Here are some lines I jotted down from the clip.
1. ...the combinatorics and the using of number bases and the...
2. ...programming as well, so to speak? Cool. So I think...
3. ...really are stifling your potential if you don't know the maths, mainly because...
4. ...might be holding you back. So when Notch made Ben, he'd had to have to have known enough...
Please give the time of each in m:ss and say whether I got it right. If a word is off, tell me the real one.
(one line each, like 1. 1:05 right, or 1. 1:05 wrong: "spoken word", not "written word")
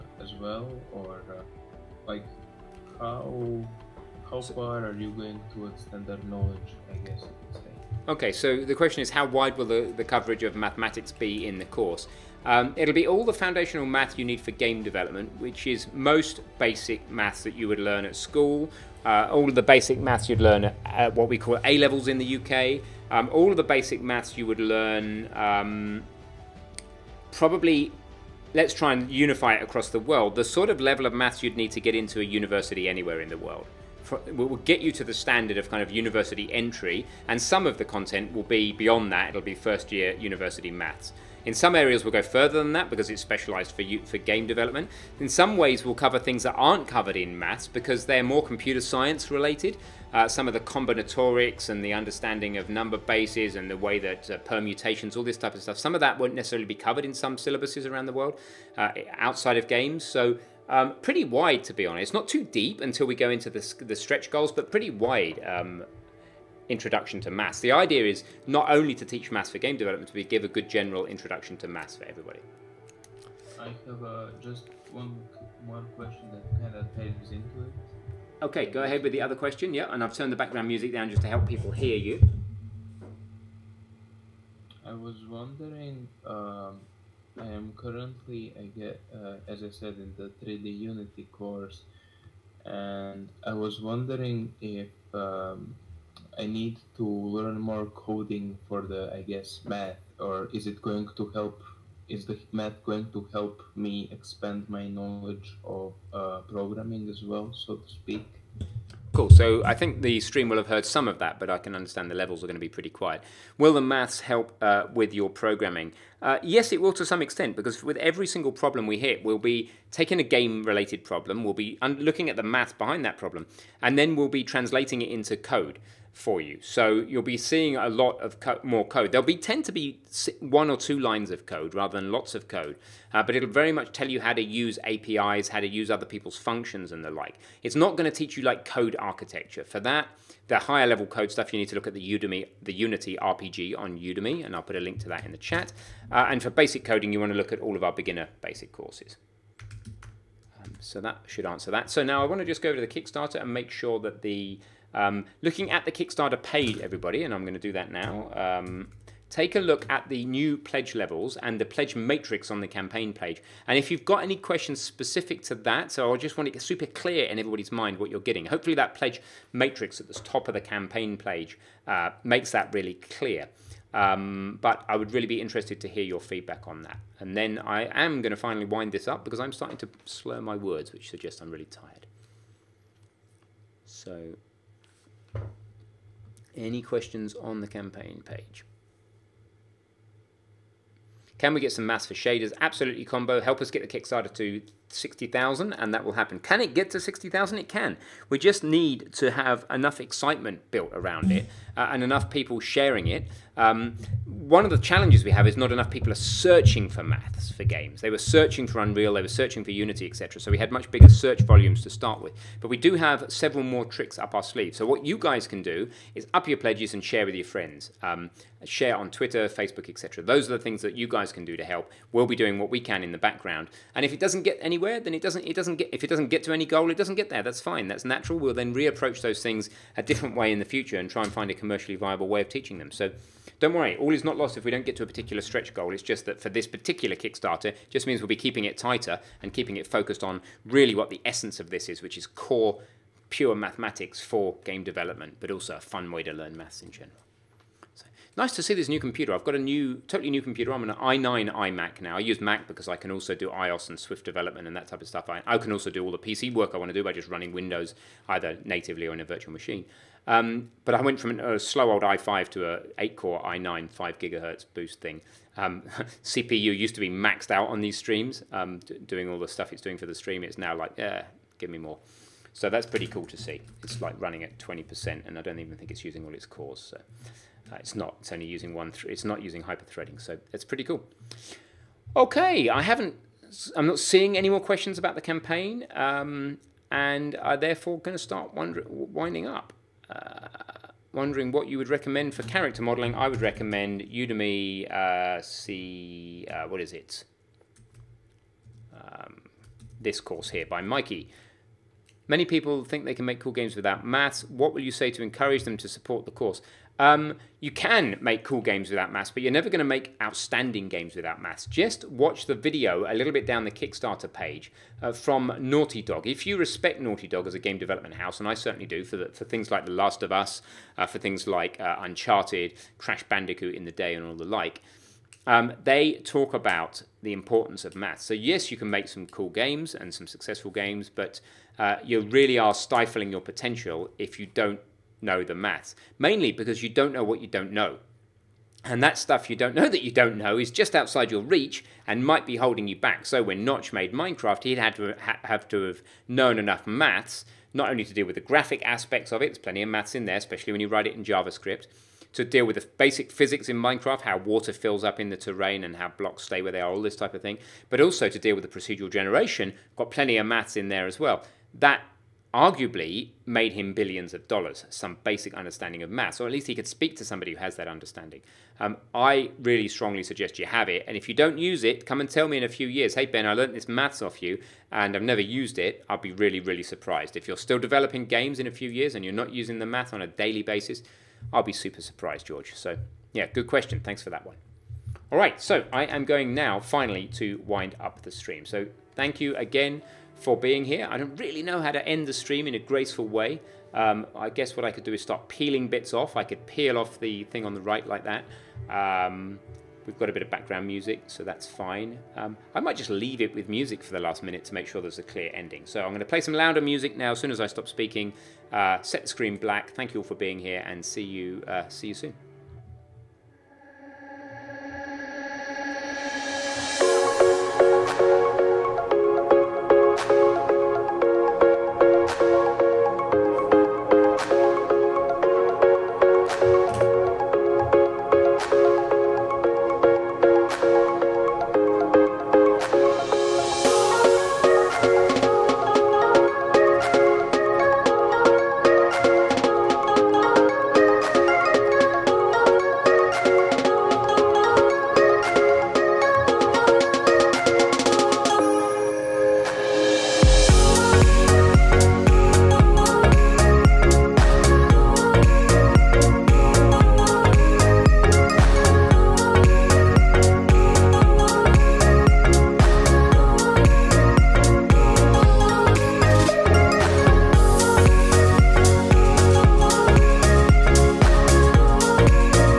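1. 0:50 wrong: "understanding", not "using"
2. 1:46 right
3. 5:32 right
4. 5:42 wrong: "Minecraft", not "Ben".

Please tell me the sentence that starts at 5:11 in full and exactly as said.
Just watch the video a little bit down the Kickstarter page uh, from Naughty Dog.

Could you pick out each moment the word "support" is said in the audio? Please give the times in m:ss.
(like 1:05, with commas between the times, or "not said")
5:05.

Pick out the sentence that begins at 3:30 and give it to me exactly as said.
So we had much bigger search volumes to start with.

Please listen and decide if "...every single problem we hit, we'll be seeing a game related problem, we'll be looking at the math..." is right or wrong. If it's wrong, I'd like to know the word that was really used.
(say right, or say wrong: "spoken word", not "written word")
wrong: "taking", not "seeing".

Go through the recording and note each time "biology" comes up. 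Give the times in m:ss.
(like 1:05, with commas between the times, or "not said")
not said.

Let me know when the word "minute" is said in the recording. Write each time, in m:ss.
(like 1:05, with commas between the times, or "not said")
6:44.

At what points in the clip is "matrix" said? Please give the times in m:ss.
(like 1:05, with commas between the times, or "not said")
2:41, 2:49.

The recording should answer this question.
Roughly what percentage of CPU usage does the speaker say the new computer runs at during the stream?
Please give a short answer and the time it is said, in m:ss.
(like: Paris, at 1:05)
20%, at 4:34.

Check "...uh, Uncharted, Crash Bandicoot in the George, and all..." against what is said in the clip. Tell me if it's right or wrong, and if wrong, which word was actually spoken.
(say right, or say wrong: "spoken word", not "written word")
wrong: "Day", not "George".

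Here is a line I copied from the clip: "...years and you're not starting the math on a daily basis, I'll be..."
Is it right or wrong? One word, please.
wrong.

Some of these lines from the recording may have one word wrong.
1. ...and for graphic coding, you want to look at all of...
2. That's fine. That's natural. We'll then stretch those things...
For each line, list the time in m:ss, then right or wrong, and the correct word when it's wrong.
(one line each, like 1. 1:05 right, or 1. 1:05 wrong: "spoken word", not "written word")
1. 2:26 wrong: "basic", not "graphic"
2. 3:47 wrong: "reapproach", not "stretch".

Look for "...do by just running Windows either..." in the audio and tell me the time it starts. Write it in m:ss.
4:16.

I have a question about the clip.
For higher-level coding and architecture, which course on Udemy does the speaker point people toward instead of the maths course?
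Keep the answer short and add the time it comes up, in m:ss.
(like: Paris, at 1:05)
Unity RPG, at 2:22.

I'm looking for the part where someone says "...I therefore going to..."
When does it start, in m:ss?
4:47.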